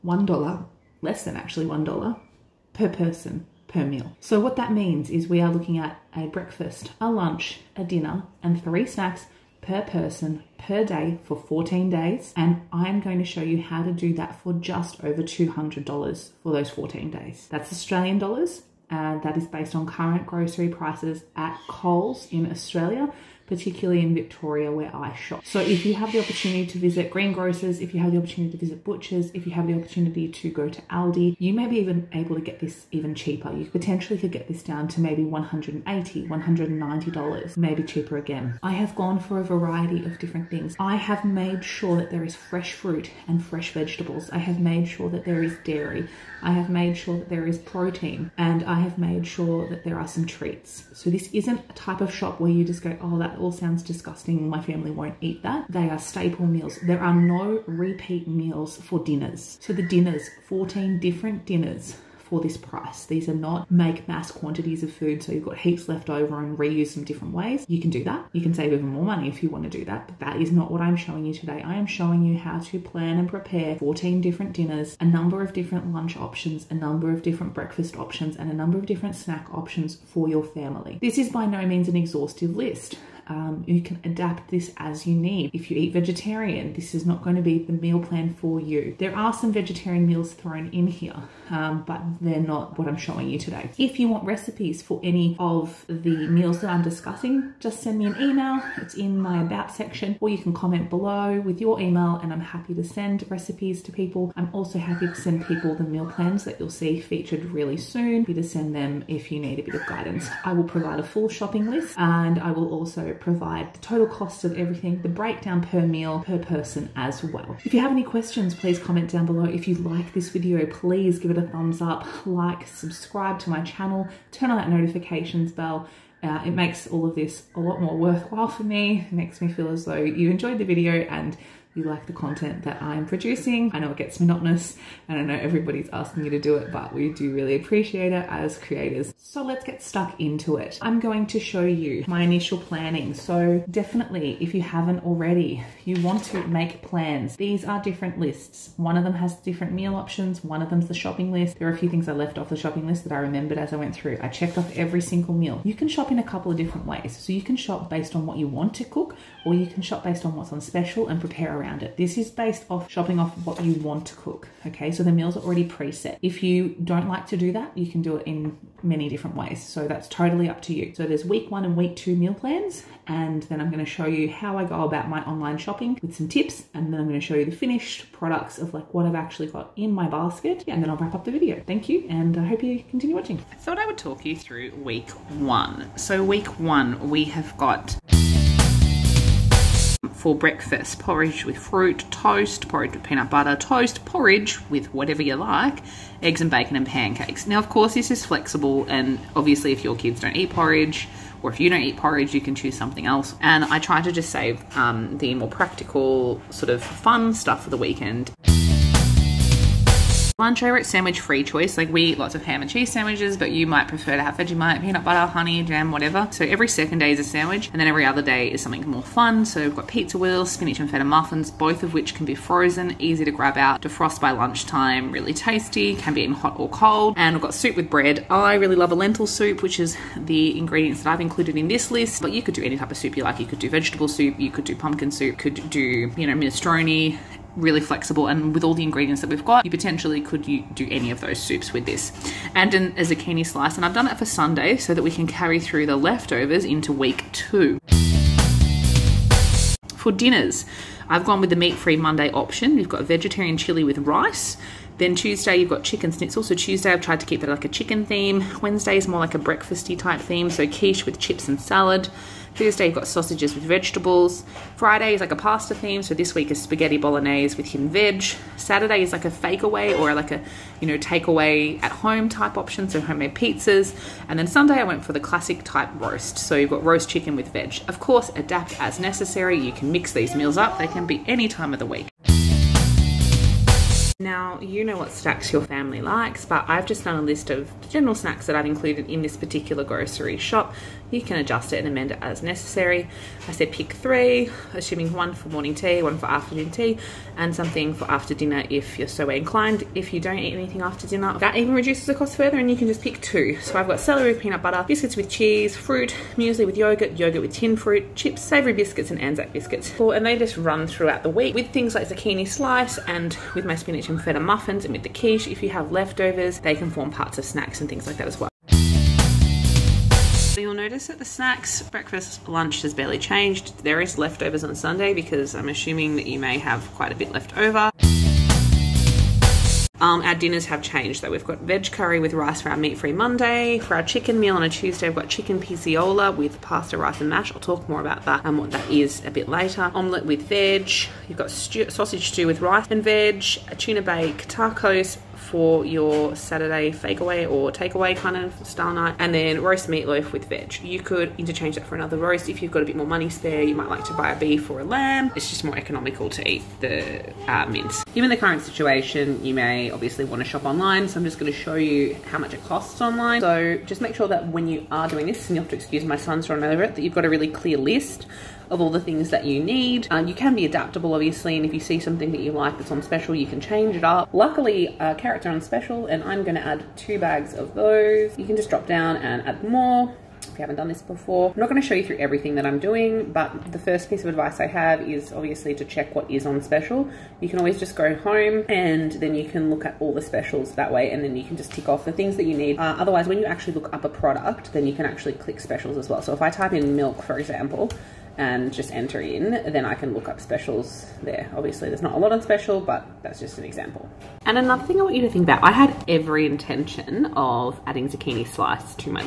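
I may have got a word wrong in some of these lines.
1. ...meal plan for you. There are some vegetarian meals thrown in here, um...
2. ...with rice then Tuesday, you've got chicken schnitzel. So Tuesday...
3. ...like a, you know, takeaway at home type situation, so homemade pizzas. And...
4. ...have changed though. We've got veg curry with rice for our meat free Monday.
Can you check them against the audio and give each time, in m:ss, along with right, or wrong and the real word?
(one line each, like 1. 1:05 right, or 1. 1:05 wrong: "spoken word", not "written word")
1. 1:27 right
2. 4:13 right
3. 4:30 wrong: "option", not "situation"
4. 5:30 right.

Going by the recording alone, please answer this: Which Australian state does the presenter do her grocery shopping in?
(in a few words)
Victoria.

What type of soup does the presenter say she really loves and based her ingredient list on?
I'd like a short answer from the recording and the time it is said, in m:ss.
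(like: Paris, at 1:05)
Lentil soup, at 3:48.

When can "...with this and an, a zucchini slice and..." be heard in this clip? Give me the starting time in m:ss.
4:01.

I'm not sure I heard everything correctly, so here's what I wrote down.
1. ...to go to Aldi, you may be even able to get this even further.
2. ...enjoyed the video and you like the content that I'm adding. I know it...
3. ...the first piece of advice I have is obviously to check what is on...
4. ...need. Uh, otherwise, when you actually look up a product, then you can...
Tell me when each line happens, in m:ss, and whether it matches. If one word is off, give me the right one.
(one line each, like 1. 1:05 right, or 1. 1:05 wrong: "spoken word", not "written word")
1. 0:30 wrong: "cheaper", not "further"
2. 2:10 wrong: "producing", not "adding"
3. 6:23 right
4. 6:32 right.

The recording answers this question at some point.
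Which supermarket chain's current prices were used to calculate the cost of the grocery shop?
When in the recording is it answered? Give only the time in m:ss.
0:21.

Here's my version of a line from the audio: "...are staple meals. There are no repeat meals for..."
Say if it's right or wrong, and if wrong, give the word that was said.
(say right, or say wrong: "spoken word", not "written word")
right.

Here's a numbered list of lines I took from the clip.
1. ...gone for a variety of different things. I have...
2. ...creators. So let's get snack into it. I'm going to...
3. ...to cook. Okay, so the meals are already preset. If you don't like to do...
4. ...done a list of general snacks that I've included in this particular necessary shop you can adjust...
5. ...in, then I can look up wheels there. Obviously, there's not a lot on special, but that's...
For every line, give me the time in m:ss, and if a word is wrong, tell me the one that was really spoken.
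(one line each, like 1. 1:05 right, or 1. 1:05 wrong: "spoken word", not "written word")
1. 0:38 right
2. 2:18 wrong: "stuck", not "snack"
3. 2:44 right
4. 4:47 wrong: "grocery", not "necessary"
5. 6:39 wrong: "specials", not "wheels".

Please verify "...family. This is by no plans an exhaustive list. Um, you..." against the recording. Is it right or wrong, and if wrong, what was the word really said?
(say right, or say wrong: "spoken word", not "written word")
wrong: "means", not "plans".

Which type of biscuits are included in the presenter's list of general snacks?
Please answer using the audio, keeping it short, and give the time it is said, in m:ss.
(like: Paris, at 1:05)
Anzac biscuits, at 5:09.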